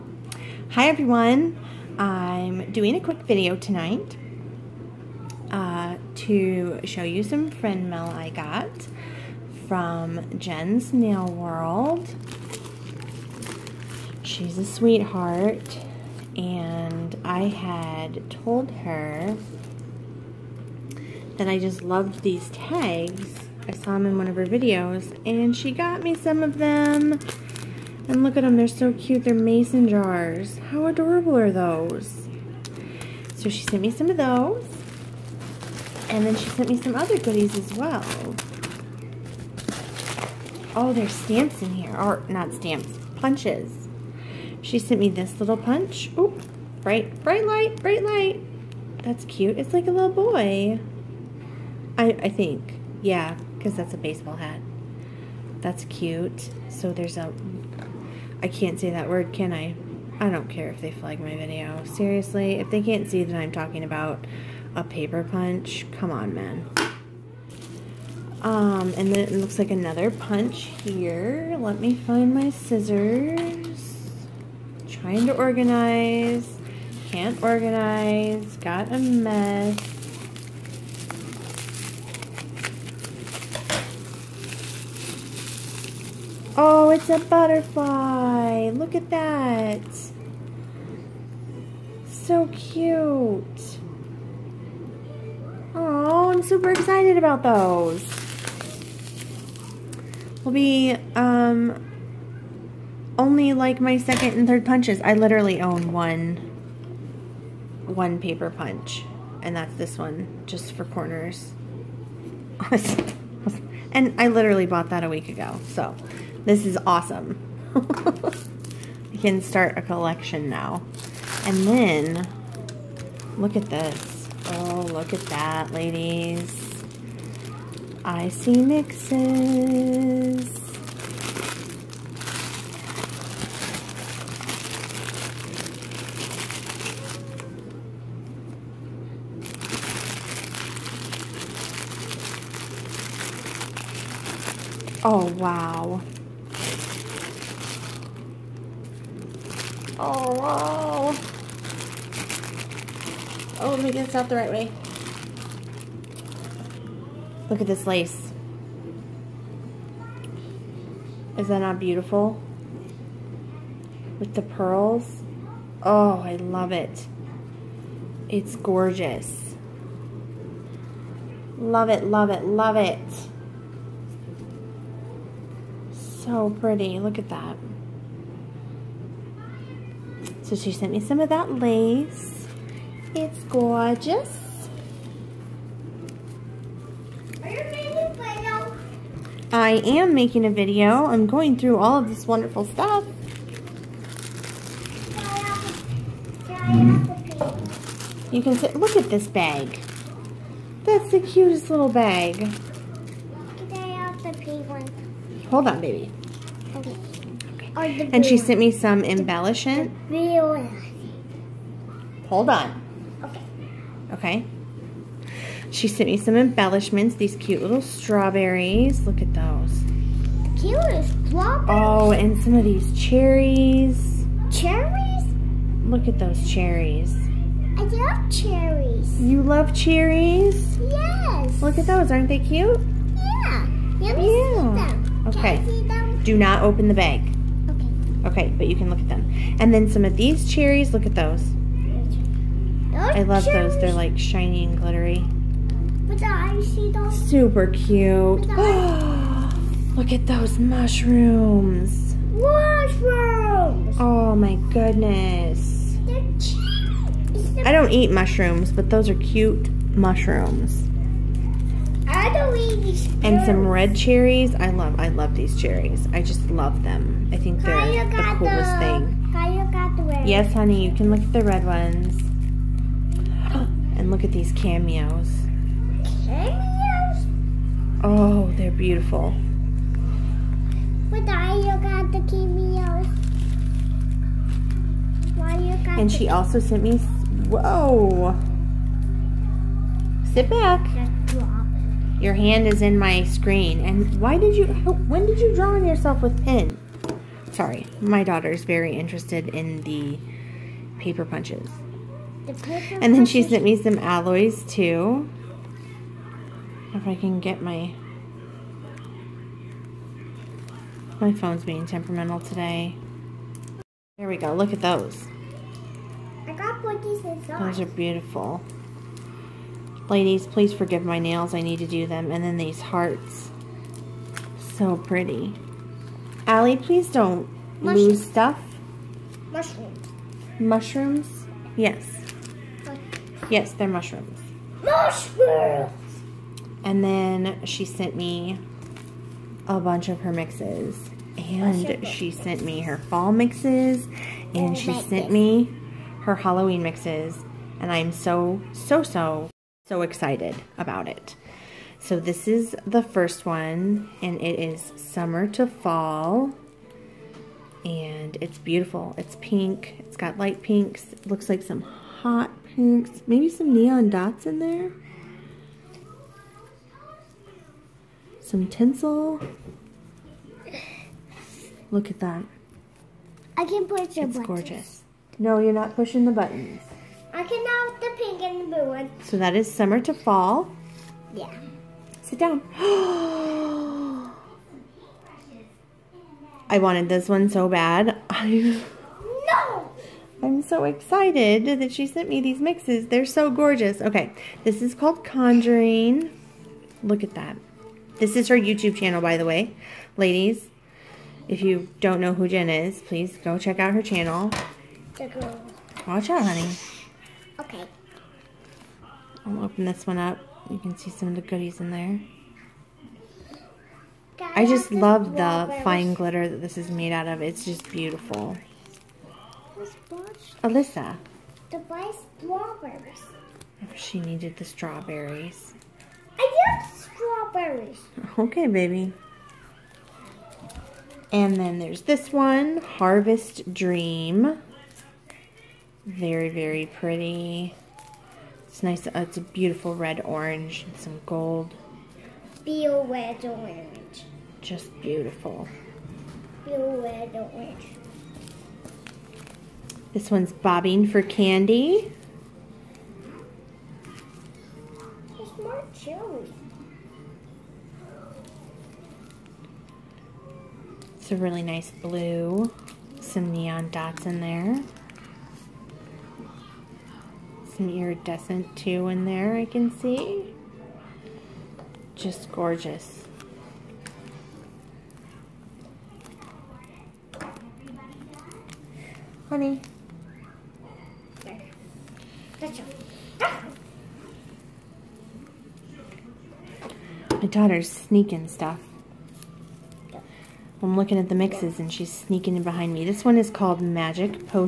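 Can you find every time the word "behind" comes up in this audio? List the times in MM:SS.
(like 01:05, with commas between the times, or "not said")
08:12.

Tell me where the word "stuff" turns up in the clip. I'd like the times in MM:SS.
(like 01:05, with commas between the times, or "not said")
03:12, 05:28, 08:08.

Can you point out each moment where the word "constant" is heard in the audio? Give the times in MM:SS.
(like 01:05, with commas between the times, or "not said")
not said.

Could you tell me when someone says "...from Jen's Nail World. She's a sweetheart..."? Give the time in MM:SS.
00:09.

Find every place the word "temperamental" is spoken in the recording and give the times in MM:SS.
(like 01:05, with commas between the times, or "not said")
05:11.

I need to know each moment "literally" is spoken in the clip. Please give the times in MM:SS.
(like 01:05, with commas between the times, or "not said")
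01:45, 01:54.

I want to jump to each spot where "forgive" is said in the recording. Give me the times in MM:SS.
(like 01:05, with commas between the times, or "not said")
05:20.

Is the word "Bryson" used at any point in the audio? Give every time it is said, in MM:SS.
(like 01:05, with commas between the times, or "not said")
not said.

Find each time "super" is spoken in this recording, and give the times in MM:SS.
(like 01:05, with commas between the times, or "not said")
01:36, 04:07.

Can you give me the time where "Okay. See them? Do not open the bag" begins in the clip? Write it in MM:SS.
03:55.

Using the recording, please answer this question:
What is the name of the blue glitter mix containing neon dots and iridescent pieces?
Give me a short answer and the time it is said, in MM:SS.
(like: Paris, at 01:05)
Bobbing for Candy, at 07:30.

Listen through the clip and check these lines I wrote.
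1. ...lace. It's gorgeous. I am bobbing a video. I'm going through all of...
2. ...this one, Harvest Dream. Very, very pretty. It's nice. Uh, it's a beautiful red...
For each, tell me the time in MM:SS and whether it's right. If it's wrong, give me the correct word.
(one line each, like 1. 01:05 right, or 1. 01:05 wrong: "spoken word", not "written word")
1. 03:01 wrong: "making", not "bobbing"
2. 07:12 right.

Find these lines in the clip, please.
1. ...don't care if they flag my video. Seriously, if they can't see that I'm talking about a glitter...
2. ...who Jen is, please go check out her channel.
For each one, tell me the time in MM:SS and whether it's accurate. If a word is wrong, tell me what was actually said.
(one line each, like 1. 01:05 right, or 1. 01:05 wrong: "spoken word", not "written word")
1. 01:00 wrong: "paper", not "glitter"
2. 06:42 right.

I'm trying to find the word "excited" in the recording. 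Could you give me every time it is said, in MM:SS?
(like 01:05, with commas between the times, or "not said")
01:36, 05:50, 06:30.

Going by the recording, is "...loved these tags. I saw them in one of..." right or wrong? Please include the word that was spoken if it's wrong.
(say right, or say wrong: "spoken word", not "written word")
right.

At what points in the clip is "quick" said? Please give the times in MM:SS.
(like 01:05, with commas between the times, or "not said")
00:02.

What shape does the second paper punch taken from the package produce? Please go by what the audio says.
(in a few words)
Butterfly.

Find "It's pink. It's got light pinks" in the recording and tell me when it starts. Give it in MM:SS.
05:59.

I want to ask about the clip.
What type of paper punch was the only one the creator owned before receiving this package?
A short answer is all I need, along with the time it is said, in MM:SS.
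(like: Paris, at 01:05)
Corners, at 01:50.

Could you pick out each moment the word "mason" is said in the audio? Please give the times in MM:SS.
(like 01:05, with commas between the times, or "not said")
00:29.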